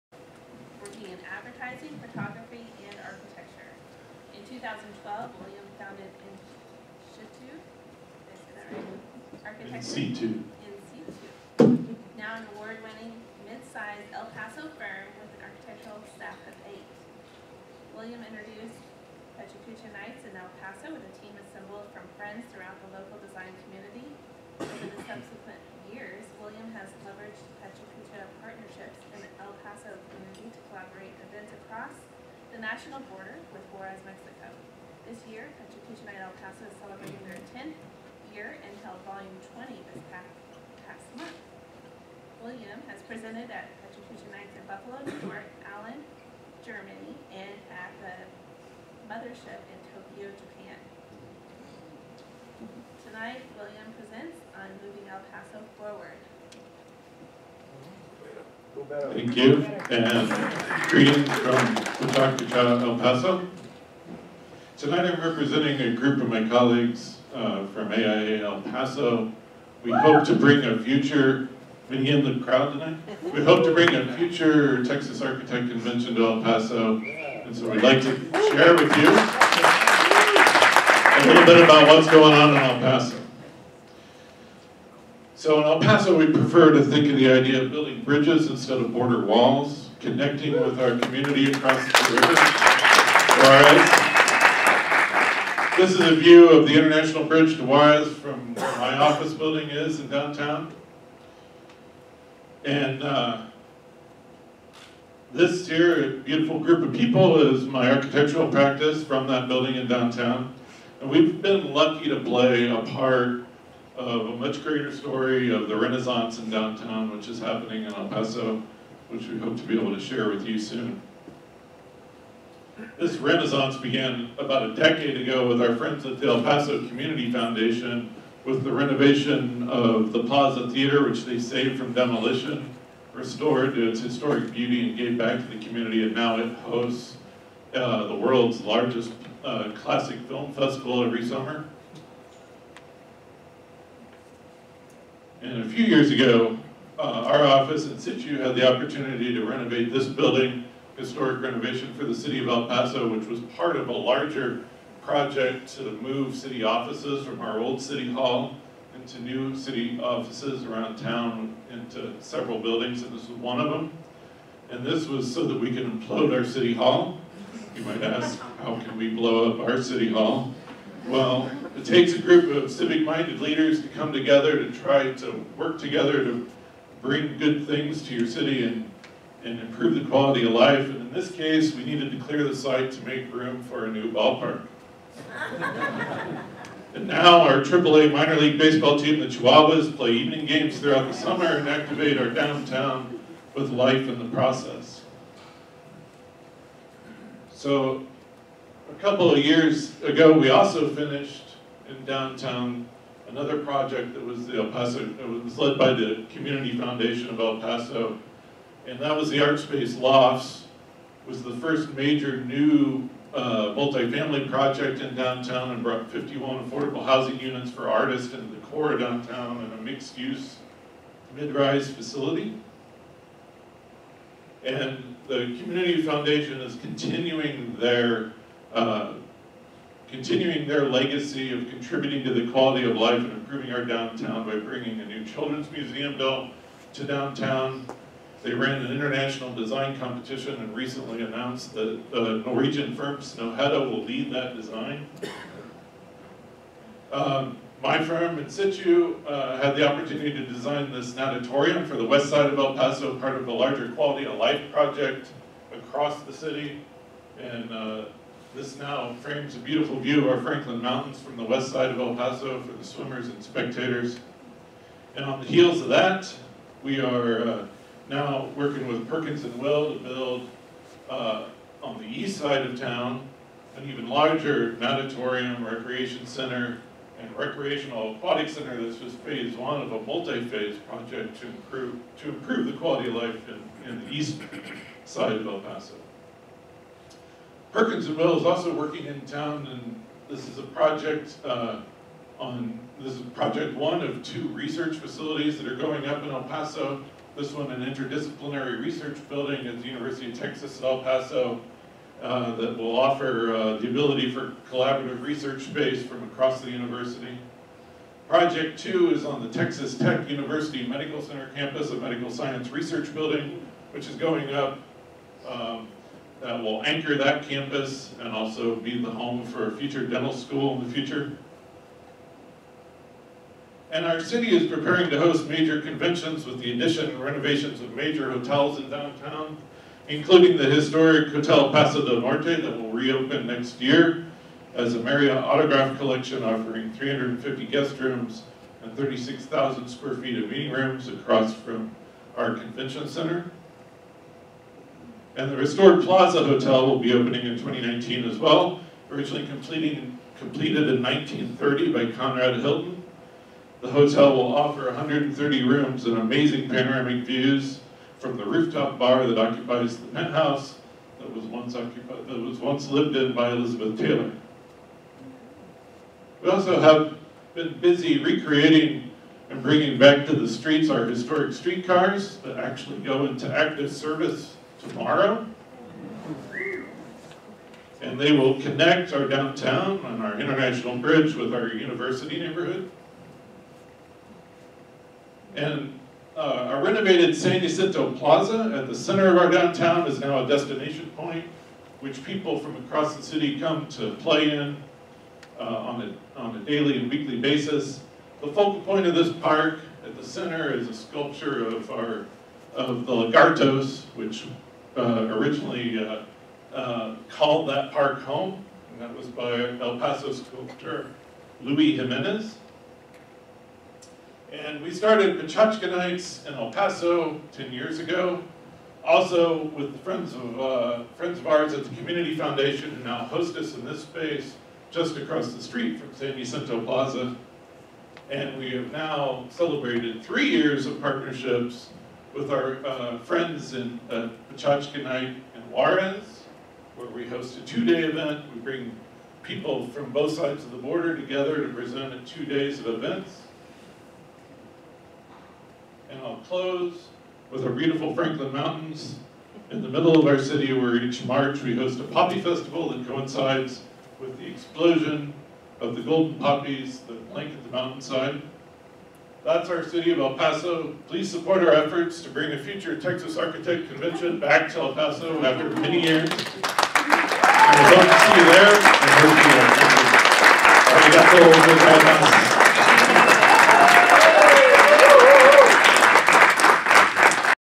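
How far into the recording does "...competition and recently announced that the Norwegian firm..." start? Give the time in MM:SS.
03:59.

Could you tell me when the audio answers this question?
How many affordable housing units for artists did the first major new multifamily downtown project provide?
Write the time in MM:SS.
03:36.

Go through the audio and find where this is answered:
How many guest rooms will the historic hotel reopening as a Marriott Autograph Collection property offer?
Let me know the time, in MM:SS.
05:36.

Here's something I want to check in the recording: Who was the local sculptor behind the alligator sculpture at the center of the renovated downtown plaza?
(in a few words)
Luis Jimenez.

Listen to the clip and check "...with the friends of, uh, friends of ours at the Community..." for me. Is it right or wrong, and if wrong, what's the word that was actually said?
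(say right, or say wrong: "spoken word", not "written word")
right.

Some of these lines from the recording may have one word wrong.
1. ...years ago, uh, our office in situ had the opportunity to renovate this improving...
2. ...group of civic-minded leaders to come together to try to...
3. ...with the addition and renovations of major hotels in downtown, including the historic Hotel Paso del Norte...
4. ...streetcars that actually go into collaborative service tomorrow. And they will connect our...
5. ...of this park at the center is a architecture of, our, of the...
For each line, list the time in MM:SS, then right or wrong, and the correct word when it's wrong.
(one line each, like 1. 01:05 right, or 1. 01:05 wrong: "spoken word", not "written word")
1. 02:25 wrong: "building", not "improving"
2. 02:52 right
3. 05:26 right
4. 06:11 wrong: "active", not "collaborative"
5. 06:39 wrong: "sculpture", not "architecture".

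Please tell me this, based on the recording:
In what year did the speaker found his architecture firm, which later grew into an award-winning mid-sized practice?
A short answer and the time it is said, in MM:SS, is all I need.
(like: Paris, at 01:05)
2012, at 00:04.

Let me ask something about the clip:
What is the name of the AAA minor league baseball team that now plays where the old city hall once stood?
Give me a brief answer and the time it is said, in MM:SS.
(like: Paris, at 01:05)
Chihuahuas, at 03:09.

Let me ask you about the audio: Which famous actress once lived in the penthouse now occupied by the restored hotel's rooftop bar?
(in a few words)
Elizabeth Taylor.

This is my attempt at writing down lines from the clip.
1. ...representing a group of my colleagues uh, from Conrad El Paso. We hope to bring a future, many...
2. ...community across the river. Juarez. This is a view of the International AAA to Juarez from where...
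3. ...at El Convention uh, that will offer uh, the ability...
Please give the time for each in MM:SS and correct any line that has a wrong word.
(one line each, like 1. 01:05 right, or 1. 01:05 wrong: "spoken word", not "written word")
1. 01:05 wrong: "AIA", not "Conrad"
2. 01:30 wrong: "Bridge", not "AAA"
3. 05:00 wrong: "Paso", not "Convention".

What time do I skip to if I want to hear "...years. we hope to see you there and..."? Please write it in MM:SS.
07:46.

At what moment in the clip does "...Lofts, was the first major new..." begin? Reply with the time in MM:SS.
03:29.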